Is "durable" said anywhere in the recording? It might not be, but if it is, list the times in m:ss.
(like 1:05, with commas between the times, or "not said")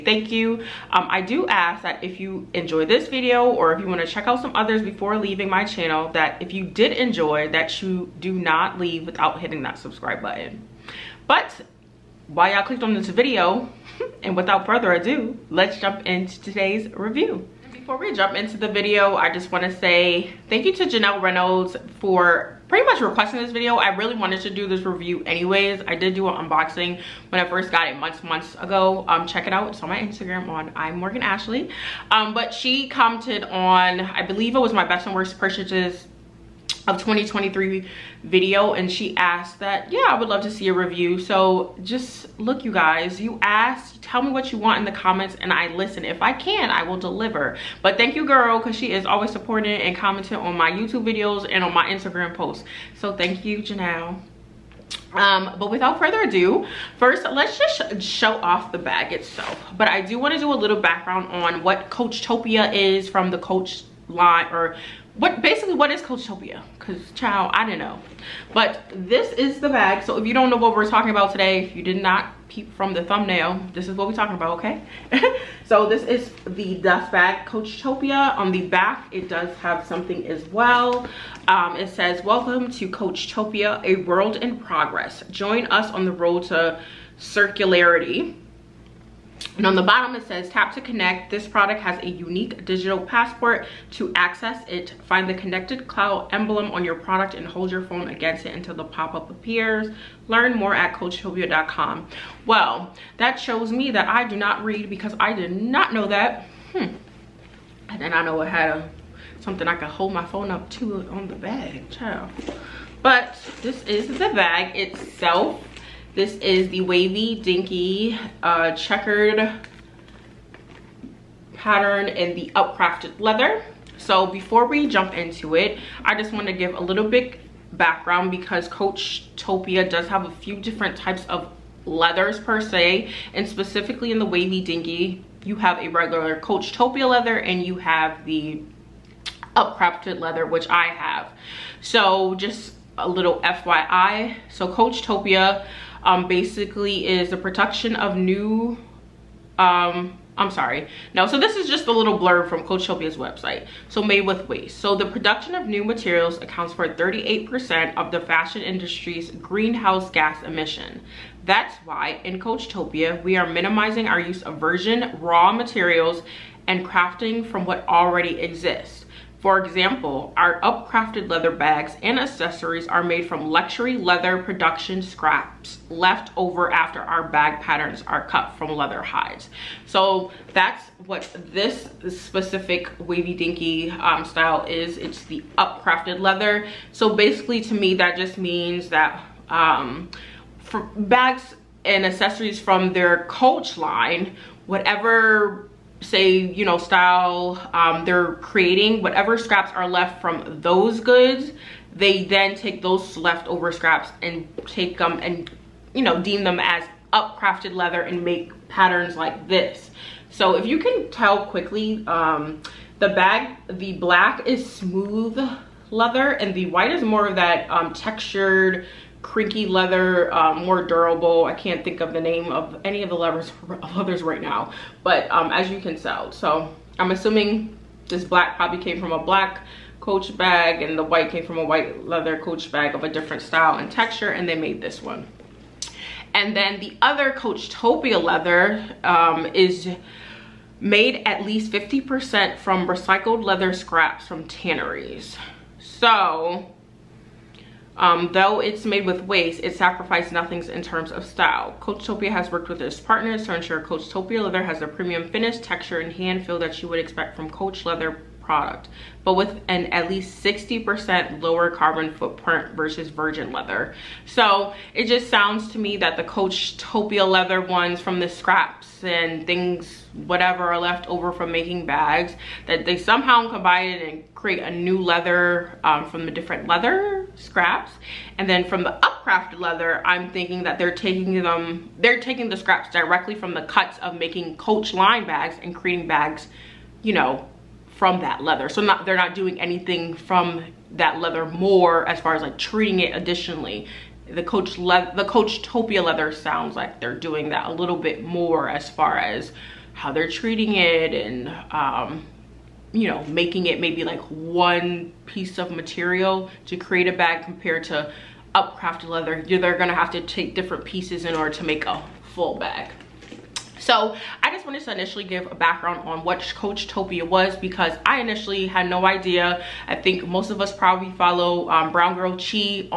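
3:40.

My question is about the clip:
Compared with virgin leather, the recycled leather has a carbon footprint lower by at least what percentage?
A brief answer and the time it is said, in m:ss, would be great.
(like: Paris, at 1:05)
60%, at 4:20.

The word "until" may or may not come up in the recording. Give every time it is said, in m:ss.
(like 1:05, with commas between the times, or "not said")
1:38.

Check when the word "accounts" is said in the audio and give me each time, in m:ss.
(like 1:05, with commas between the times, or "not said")
2:36.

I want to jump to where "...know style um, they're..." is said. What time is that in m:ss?
3:16.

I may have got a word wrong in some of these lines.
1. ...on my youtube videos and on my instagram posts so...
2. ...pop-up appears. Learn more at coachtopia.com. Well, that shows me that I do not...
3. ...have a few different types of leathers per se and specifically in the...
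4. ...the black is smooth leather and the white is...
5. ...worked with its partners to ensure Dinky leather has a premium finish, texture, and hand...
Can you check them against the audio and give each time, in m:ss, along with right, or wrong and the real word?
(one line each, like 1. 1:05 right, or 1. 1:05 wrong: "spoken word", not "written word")
1. 0:50 right
2. 1:38 right
3. 2:10 right
4. 3:33 right
5. 4:12 wrong: "Coachtopia", not "Dinky".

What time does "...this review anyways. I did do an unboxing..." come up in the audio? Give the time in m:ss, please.
0:24.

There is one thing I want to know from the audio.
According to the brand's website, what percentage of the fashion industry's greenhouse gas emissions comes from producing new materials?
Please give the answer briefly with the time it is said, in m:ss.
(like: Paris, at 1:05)
38%, at 2:36.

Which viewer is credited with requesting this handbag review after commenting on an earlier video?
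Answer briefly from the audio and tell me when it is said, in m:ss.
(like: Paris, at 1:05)
Janelle Reynolds, at 0:20.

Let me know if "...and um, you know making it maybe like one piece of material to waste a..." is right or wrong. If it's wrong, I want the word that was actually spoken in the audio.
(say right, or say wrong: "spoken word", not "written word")
wrong: "create", not "waste".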